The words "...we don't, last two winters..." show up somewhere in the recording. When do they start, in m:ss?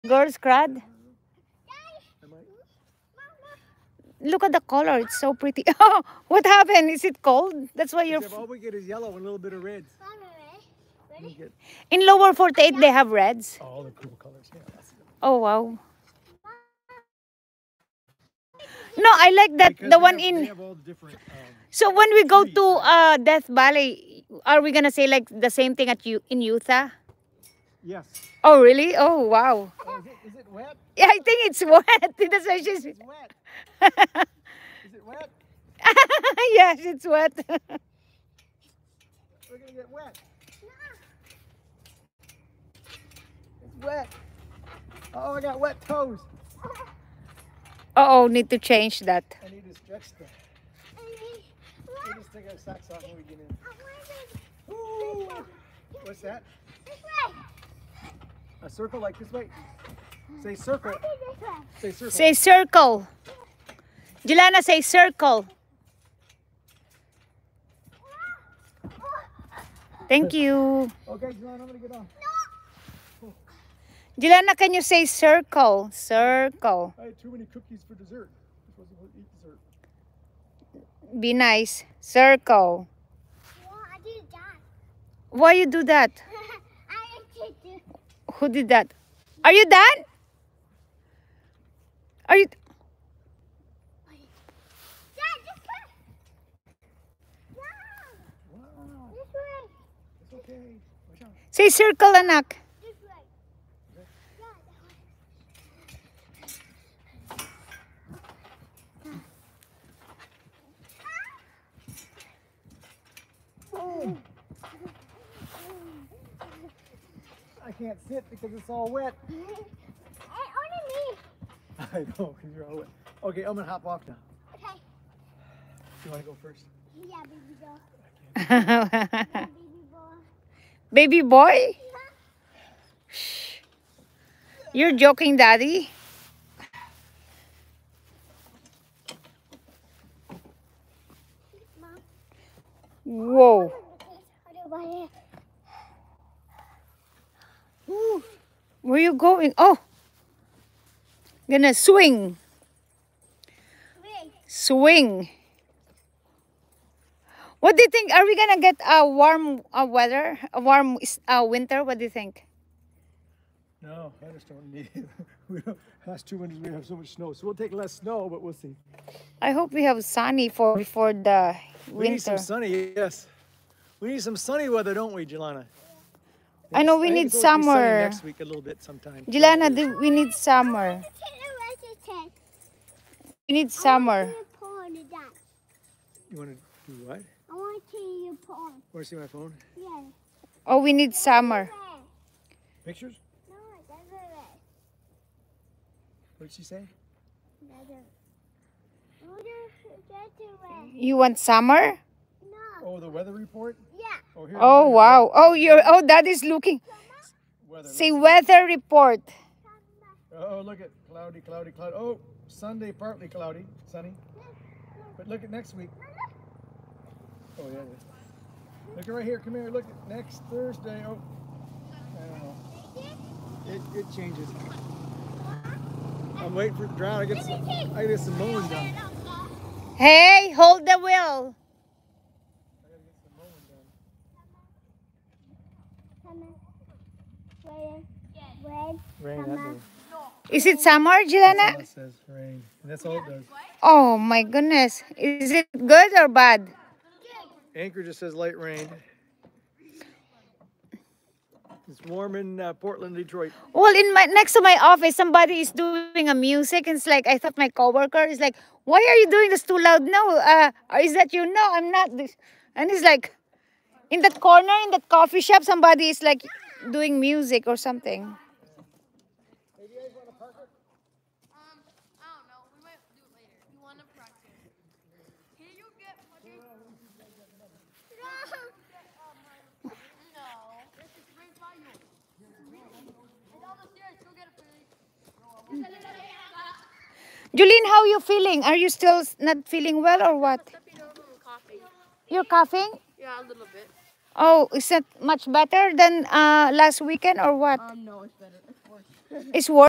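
2:45.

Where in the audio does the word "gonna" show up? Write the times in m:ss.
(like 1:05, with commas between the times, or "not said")
2:31, 2:38.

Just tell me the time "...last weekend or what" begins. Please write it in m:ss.
4:56.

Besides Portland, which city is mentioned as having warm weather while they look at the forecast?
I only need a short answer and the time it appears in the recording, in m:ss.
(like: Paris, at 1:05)
Detroit, at 4:13.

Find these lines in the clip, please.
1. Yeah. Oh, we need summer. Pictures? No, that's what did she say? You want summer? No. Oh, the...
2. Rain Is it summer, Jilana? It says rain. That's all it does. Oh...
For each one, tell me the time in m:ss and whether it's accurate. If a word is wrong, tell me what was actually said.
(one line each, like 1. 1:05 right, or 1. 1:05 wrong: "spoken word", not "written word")
1. 3:09 right
2. 3:59 right.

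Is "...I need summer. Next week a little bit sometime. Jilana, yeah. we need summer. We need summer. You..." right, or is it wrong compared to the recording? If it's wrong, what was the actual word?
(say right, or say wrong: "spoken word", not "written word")
right.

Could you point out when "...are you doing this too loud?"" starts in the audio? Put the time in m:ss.
4:18.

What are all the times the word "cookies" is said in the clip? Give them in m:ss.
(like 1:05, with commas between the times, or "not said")
1:17.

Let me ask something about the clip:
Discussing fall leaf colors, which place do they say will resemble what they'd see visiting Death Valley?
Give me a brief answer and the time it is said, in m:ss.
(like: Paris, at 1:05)
Utah, at 0:26.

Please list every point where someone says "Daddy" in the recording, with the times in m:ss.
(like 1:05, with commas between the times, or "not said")
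2:15.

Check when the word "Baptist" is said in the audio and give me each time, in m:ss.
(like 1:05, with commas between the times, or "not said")
not said.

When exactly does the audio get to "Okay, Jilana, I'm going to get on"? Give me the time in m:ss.
1:11.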